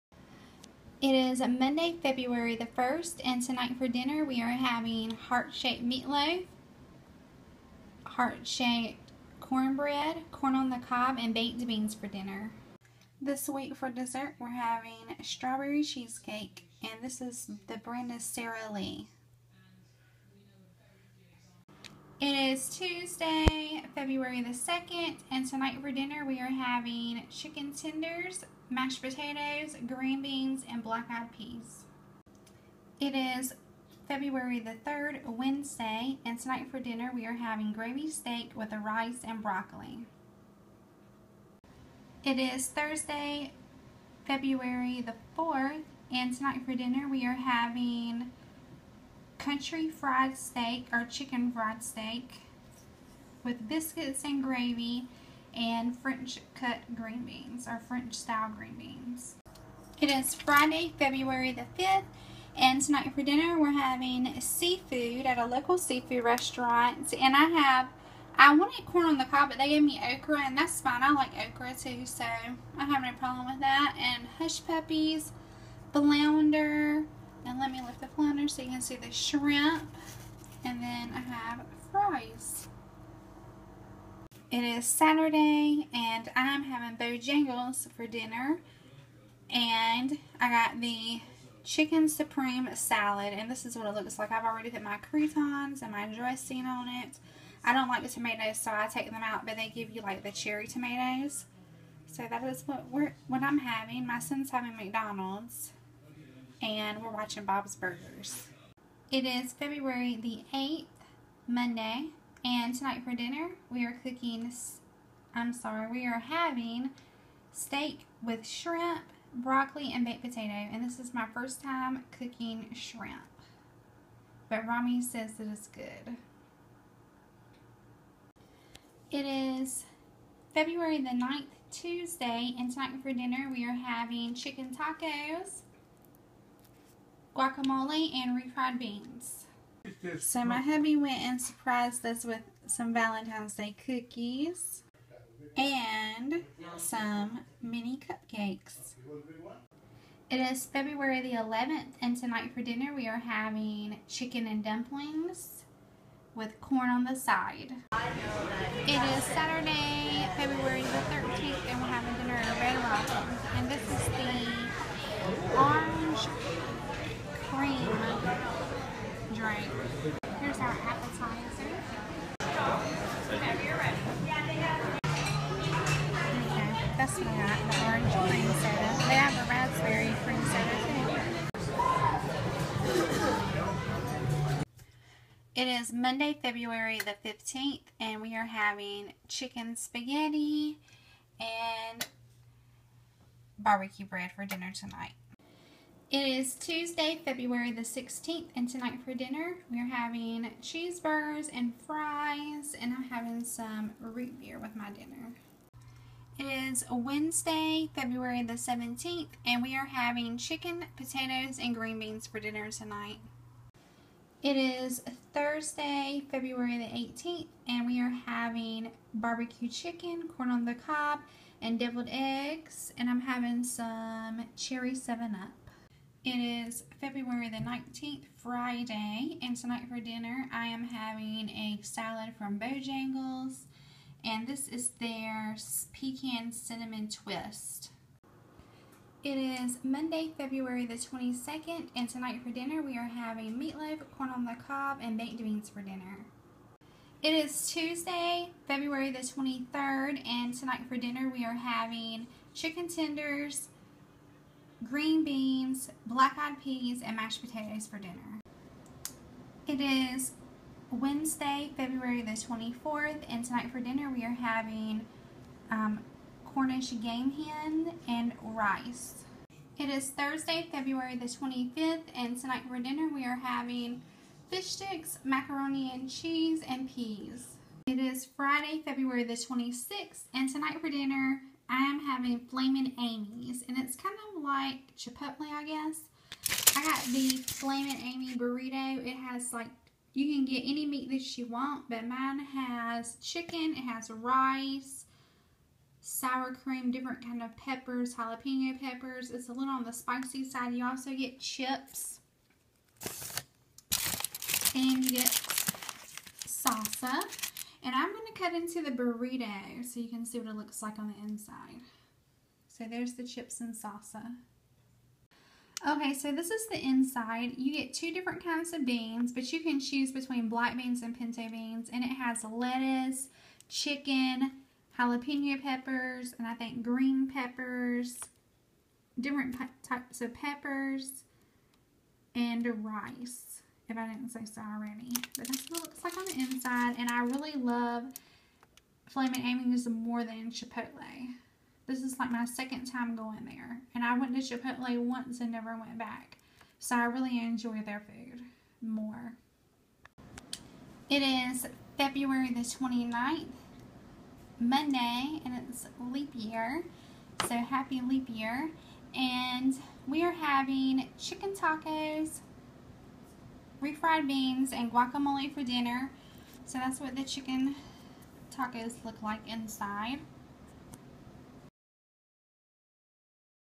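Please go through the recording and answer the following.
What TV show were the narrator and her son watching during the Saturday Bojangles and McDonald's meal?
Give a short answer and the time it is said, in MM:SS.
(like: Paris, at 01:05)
Bob's Burgers, at 01:47.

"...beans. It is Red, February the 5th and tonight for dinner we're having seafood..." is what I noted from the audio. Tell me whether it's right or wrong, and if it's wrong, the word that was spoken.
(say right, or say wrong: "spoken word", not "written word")
wrong: "Friday", not "Red".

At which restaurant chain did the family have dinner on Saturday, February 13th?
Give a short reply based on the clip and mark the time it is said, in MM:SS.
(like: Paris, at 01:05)
Red Robin, at 02:42.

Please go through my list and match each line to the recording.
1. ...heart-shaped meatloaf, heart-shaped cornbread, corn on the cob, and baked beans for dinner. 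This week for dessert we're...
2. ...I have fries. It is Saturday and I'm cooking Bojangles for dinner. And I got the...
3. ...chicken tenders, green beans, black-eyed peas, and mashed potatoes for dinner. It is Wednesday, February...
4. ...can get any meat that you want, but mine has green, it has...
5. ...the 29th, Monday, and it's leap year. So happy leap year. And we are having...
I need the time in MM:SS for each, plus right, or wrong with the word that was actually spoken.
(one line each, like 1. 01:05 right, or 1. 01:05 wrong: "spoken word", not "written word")
1. 00:05 right
2. 01:21 wrong: "having", not "cooking"
3. 04:12 right
4. 04:50 wrong: "chicken", not "green"
5. 05:52 right.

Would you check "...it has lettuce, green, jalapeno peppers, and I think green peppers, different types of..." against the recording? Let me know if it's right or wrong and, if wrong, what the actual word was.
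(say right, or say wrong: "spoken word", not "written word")
wrong: "chicken", not "green".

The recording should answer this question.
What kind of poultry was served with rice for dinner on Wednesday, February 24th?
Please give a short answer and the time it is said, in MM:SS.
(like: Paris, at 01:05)
Cornish game hen, at 04:26.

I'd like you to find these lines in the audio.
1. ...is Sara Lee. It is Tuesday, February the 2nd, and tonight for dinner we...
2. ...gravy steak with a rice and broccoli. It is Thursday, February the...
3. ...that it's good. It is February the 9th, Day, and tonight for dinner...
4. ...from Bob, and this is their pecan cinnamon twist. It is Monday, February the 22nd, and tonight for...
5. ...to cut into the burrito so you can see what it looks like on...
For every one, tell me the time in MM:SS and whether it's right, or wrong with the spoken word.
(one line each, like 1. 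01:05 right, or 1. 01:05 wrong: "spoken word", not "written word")
1. 00:18 right
2. 00:37 right
3. 02:05 wrong: "Tuesday", not "Day"
4. 03:52 wrong: "Bojangles", not "Bob"
5. 05:08 right.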